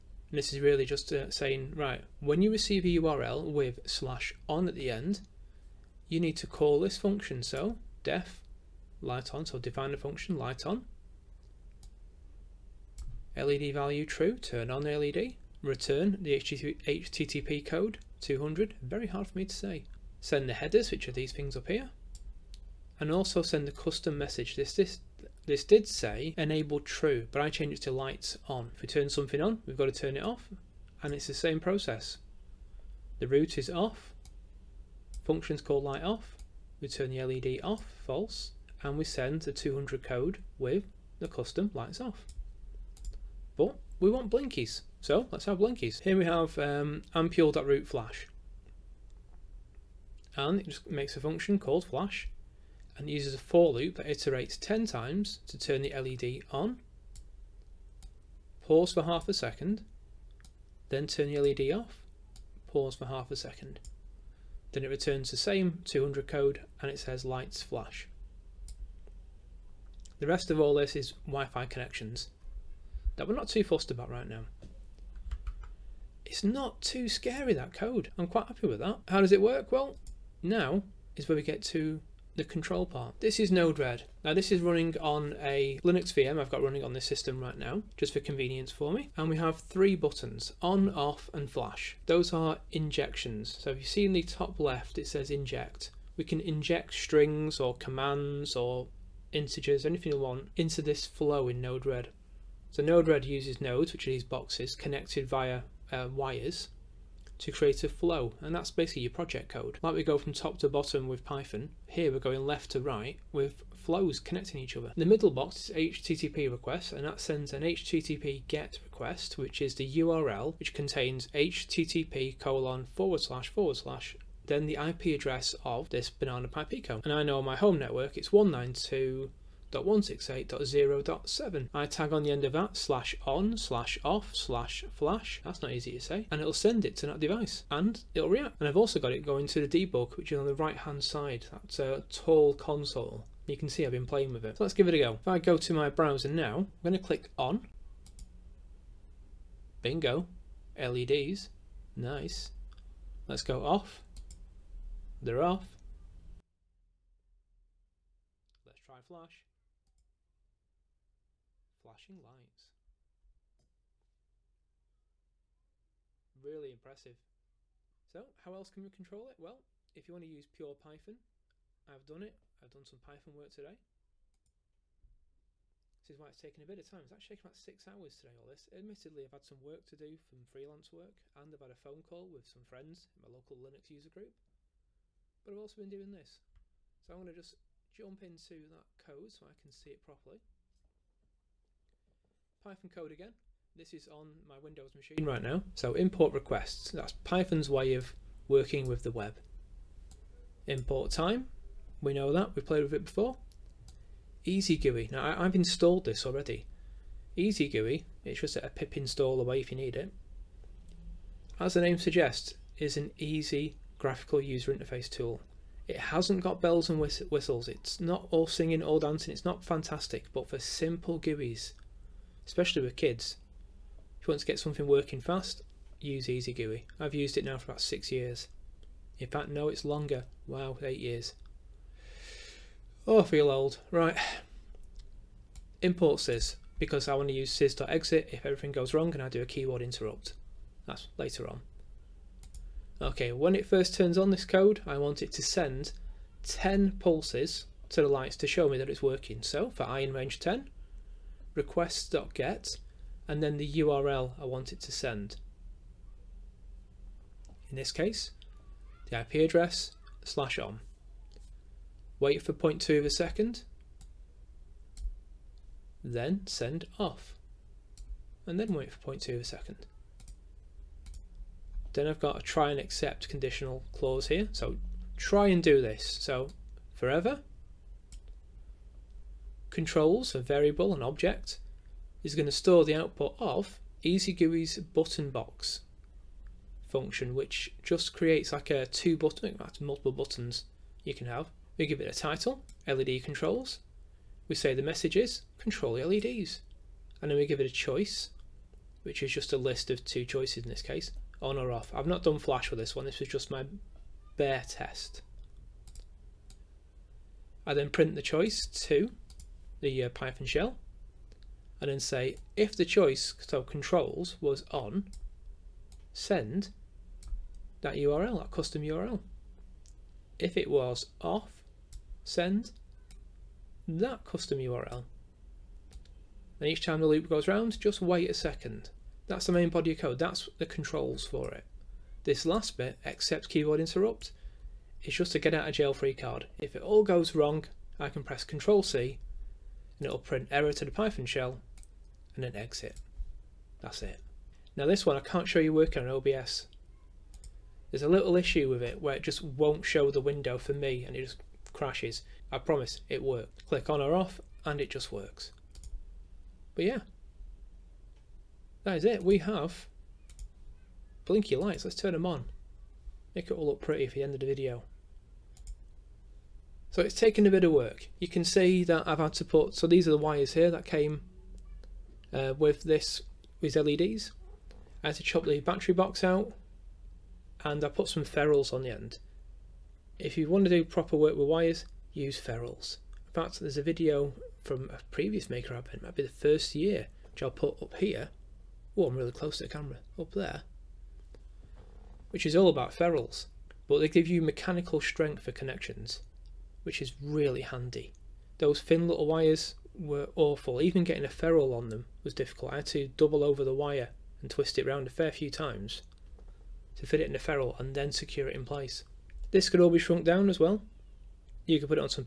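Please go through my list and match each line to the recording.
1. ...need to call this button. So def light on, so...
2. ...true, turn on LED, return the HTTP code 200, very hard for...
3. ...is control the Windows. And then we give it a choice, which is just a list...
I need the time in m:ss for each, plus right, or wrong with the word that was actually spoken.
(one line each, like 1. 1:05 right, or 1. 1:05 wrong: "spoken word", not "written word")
1. 0:06 wrong: "function", not "button"
2. 0:14 right
3. 4:55 wrong: "LEDs", not "Windows".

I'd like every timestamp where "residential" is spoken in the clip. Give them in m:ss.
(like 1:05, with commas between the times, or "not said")
not said.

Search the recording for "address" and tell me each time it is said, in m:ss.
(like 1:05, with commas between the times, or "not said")
2:05, 4:19.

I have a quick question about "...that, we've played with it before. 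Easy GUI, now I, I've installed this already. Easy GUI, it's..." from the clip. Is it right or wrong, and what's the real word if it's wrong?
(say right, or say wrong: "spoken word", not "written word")
right.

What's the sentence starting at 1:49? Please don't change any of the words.
Like we go from top to bottom with Python, here we're going left to right with flows connecting each other.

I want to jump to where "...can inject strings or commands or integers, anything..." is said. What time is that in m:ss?
1:36.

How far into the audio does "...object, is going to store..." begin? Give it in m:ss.
4:41.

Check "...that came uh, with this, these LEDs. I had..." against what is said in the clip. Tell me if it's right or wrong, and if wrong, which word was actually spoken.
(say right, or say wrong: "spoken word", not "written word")
right.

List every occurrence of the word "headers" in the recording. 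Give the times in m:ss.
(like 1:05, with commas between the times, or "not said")
0:20.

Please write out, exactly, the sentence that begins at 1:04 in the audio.
Then it returns the same 200 code and it says lights flash.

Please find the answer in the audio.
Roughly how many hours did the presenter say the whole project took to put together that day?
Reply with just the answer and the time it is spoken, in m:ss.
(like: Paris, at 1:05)
6 hours, at 2:57.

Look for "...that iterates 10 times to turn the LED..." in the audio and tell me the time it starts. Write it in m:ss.
0:53.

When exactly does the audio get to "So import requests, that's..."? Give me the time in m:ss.
3:15.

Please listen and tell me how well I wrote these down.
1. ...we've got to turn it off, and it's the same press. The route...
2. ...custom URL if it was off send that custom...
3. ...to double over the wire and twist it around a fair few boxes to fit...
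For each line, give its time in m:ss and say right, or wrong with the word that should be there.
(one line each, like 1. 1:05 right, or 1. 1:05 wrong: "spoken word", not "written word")
1. 0:29 wrong: "process", not "press"
2. 5:18 right
3. 6:42 wrong: "times", not "boxes".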